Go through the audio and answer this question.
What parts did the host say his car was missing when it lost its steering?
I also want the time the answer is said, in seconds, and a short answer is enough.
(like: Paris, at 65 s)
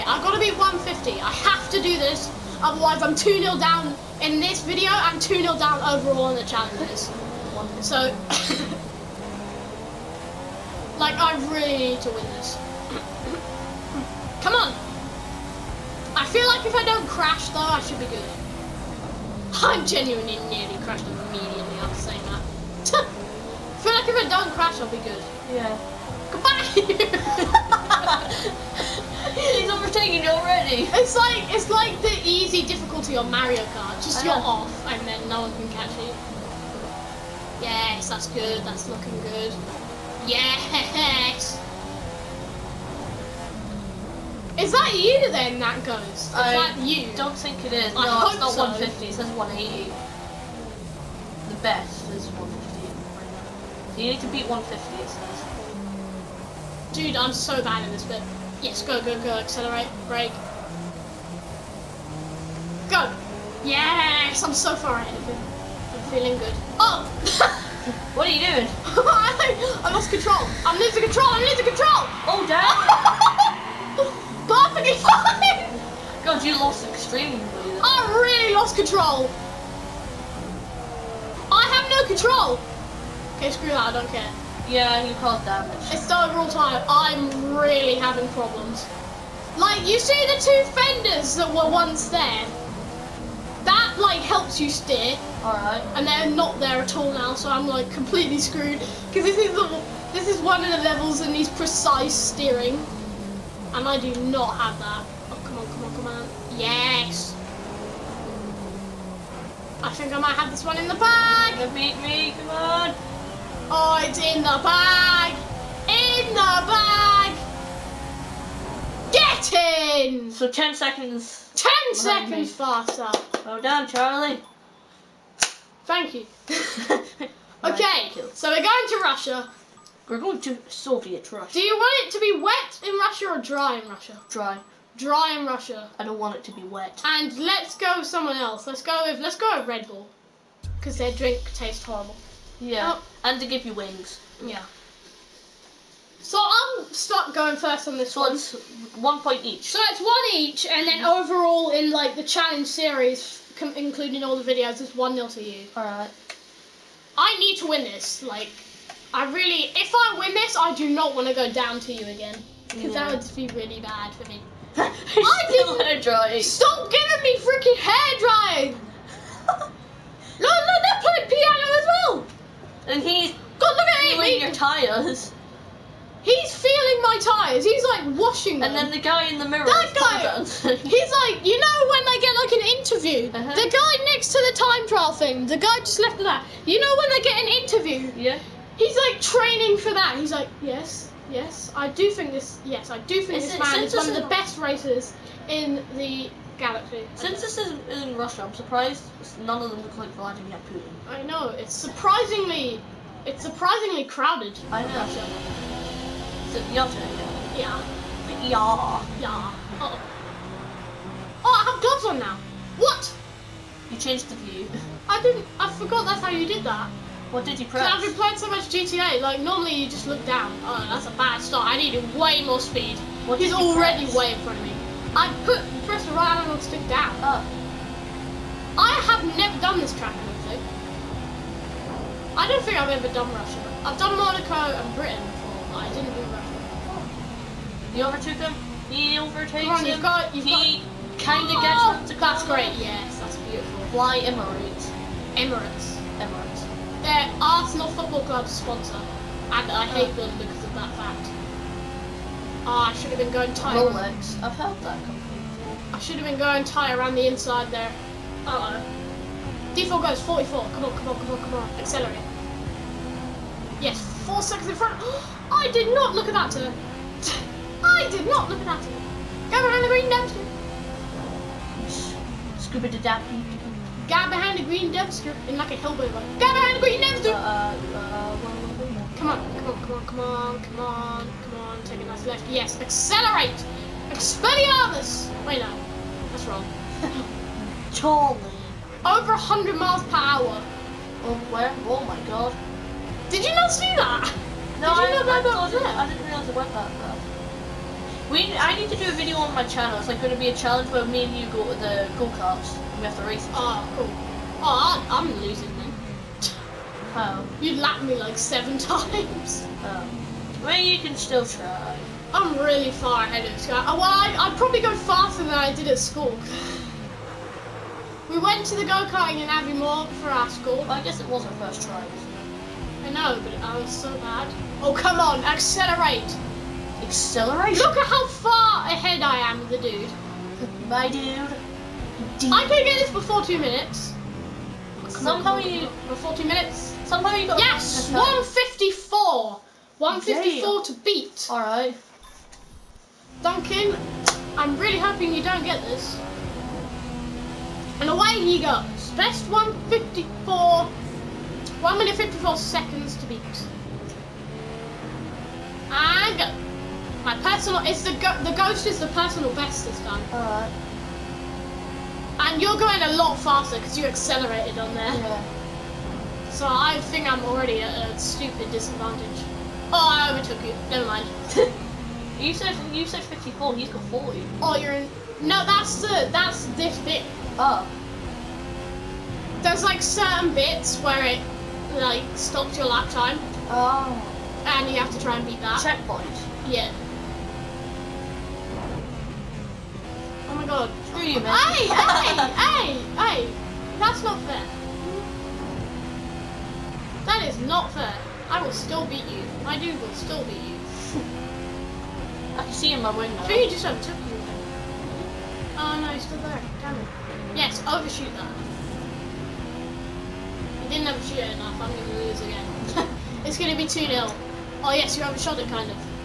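fenders, at 90 s.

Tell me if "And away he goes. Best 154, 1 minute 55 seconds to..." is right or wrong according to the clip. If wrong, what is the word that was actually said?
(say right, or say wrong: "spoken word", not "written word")
wrong: "54", not "55".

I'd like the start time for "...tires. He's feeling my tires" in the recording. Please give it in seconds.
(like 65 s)
174 s.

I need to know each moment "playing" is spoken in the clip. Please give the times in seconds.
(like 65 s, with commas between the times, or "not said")
171 s, 218 s.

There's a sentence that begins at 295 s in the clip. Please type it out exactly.
I didn't realise it went that fast.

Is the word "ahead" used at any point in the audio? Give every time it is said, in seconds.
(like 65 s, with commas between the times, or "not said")
64 s, 313 s, 328 s.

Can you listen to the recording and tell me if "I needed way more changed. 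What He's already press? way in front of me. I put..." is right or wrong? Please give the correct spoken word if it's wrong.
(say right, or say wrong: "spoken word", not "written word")
wrong: "speed", not "changed".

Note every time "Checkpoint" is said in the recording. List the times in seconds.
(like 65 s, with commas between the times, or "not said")
385 s.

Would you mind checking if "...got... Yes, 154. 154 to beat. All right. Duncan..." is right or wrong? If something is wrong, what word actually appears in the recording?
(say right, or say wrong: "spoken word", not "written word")
right.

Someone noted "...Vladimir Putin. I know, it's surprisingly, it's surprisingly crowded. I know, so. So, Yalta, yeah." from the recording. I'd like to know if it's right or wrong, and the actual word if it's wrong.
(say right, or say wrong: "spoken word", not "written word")
right.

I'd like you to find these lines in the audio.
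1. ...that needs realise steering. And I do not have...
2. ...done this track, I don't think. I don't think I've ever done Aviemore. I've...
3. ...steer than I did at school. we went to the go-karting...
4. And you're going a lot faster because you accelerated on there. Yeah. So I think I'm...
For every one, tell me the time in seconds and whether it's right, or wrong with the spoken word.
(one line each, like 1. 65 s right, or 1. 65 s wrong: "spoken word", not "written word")
1. 101 s wrong: "precise", not "realise"
2. 229 s wrong: "Russia", not "Aviemore"
3. 314 s wrong: "faster", not "steer"
4. 362 s right.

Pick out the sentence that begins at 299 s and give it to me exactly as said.
It's like going to be a challenge where me and you go to the go-karts.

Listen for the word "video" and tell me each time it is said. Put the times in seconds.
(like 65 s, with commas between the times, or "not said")
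4 s, 154 s, 299 s.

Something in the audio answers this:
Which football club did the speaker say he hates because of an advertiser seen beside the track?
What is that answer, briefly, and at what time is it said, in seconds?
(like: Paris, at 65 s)
Arsenal, at 247 s.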